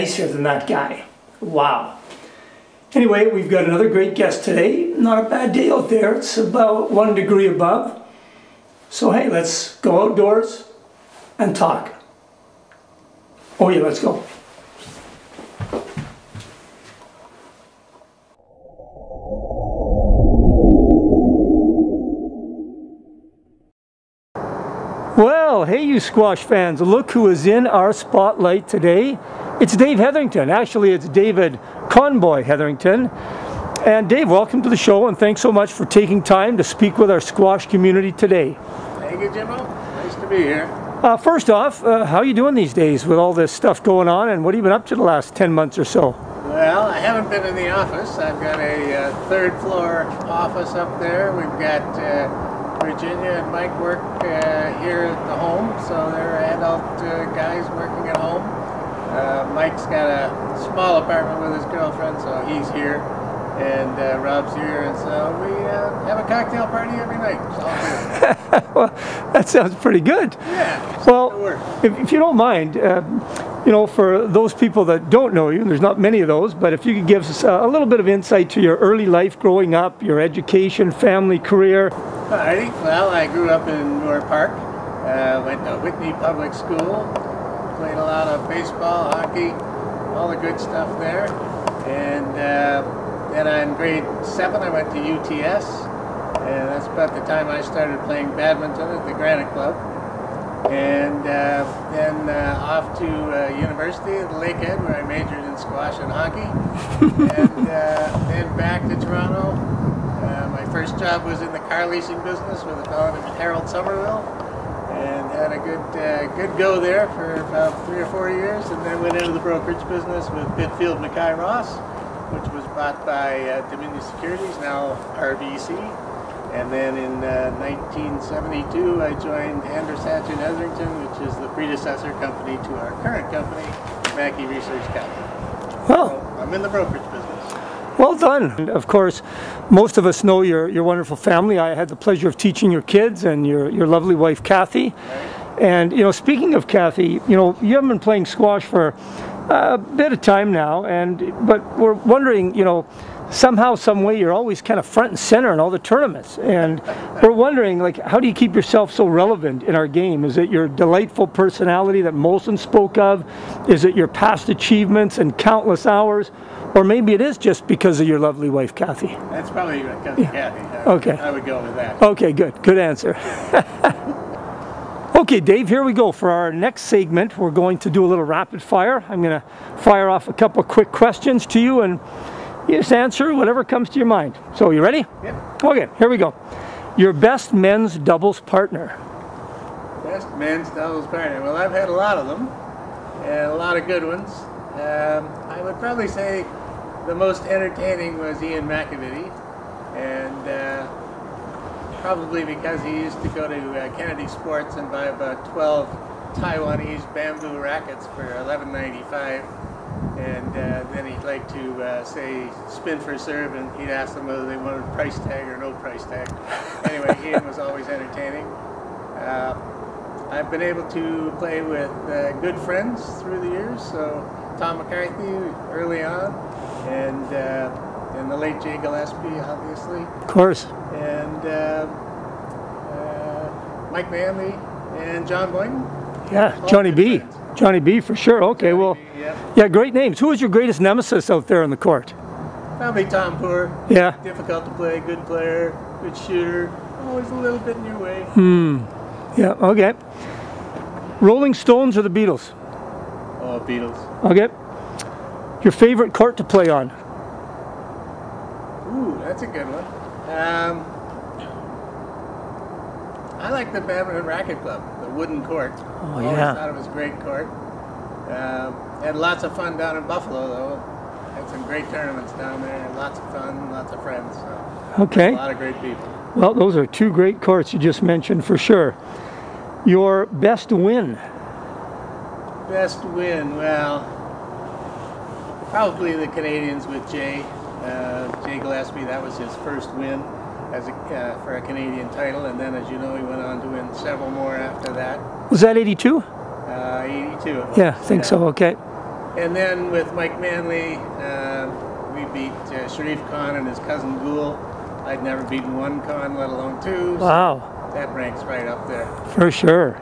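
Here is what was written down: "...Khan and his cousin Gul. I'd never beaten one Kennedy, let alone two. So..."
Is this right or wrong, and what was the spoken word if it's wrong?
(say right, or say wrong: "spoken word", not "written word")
wrong: "Khan", not "Kennedy".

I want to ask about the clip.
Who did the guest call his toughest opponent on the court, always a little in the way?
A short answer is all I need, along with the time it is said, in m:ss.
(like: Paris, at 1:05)
Tom Poor, at 4:03.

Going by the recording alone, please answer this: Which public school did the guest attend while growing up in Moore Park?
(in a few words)
Whitney Public School.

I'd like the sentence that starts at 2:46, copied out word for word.
Or maybe it is just because of your lovely wife, Kathy.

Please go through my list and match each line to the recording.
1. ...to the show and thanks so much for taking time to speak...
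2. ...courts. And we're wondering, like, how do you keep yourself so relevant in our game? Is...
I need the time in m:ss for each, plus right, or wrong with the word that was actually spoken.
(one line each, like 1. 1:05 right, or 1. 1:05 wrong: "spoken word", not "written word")
1. 0:34 right
2. 2:35 wrong: "tournaments", not "courts".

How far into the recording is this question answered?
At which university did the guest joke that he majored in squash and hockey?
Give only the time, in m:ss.
1:44.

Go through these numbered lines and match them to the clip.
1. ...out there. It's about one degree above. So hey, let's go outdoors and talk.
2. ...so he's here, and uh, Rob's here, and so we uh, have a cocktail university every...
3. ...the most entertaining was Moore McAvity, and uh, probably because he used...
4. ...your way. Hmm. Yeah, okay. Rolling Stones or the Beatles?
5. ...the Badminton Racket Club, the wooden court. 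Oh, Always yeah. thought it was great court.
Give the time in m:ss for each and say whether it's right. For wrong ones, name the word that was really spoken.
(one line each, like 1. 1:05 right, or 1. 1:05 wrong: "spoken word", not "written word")
1. 0:05 right
2. 1:02 wrong: "party", not "university"
3. 3:17 wrong: "Ian", not "Moore"
4. 4:07 right
5. 4:23 right.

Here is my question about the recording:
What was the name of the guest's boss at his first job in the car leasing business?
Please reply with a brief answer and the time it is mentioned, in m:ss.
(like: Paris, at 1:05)
Harold Somerville, at 1:53.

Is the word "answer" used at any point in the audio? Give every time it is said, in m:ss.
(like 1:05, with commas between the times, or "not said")
2:52, 3:02.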